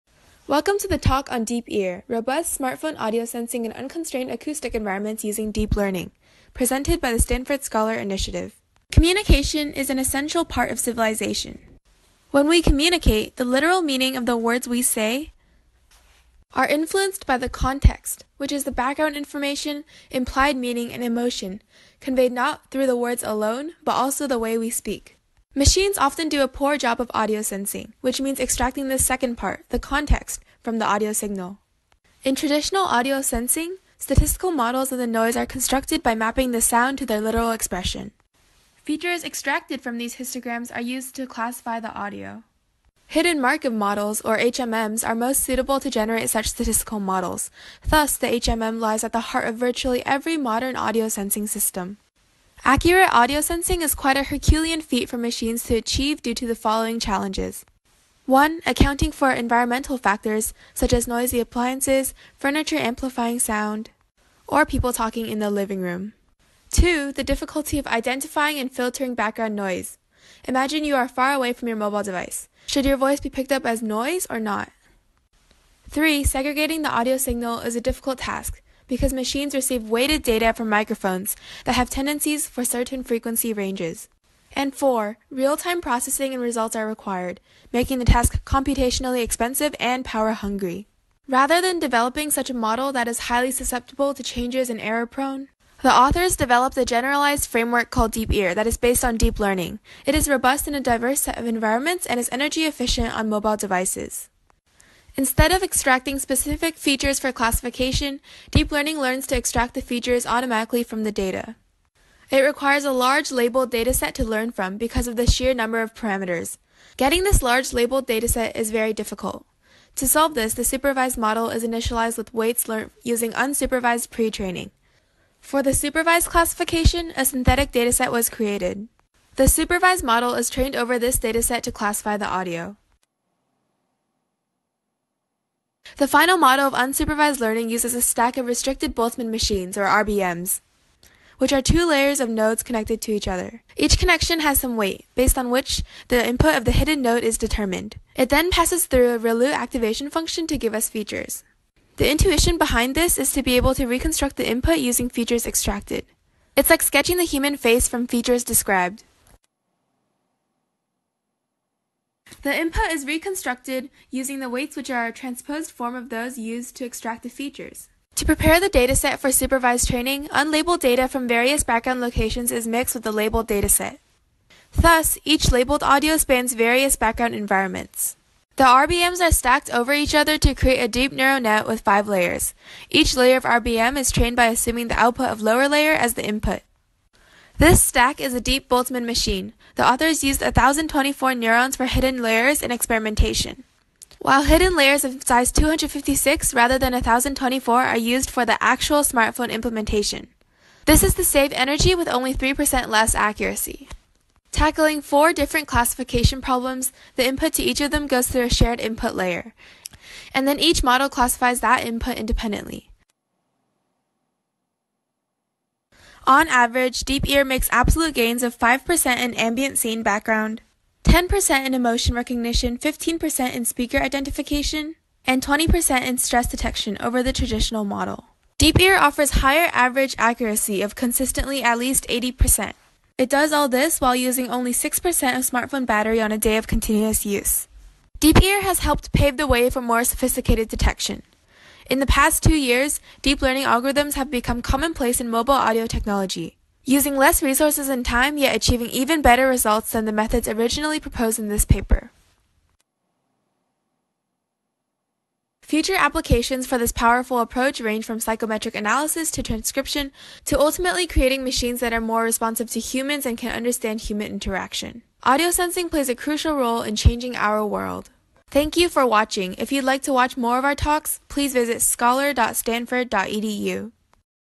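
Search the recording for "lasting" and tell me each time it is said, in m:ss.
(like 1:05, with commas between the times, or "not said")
not said.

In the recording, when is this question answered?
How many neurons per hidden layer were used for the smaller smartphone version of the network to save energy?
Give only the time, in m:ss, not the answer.
3:15.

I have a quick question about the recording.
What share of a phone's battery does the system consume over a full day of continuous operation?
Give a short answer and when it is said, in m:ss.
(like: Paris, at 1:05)
6%, at 3:54.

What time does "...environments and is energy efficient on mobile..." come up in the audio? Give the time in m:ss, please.
1:41.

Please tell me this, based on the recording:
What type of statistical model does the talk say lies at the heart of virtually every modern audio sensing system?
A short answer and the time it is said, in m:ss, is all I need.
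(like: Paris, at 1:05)
Hidden Markov models, at 0:43.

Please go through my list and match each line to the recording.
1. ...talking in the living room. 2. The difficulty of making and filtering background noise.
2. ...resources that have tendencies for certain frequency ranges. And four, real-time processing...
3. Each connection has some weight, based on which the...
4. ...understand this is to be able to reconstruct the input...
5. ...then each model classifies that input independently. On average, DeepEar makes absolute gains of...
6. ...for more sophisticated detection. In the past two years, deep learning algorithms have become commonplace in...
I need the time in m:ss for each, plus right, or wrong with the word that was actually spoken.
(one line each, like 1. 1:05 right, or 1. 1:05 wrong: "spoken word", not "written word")
1. 1:04 wrong: "identifying", not "making"
2. 1:20 wrong: "microphones", not "resources"
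3. 2:23 right
4. 2:32 wrong: "behind", not "understand"
5. 3:30 right
6. 3:59 right.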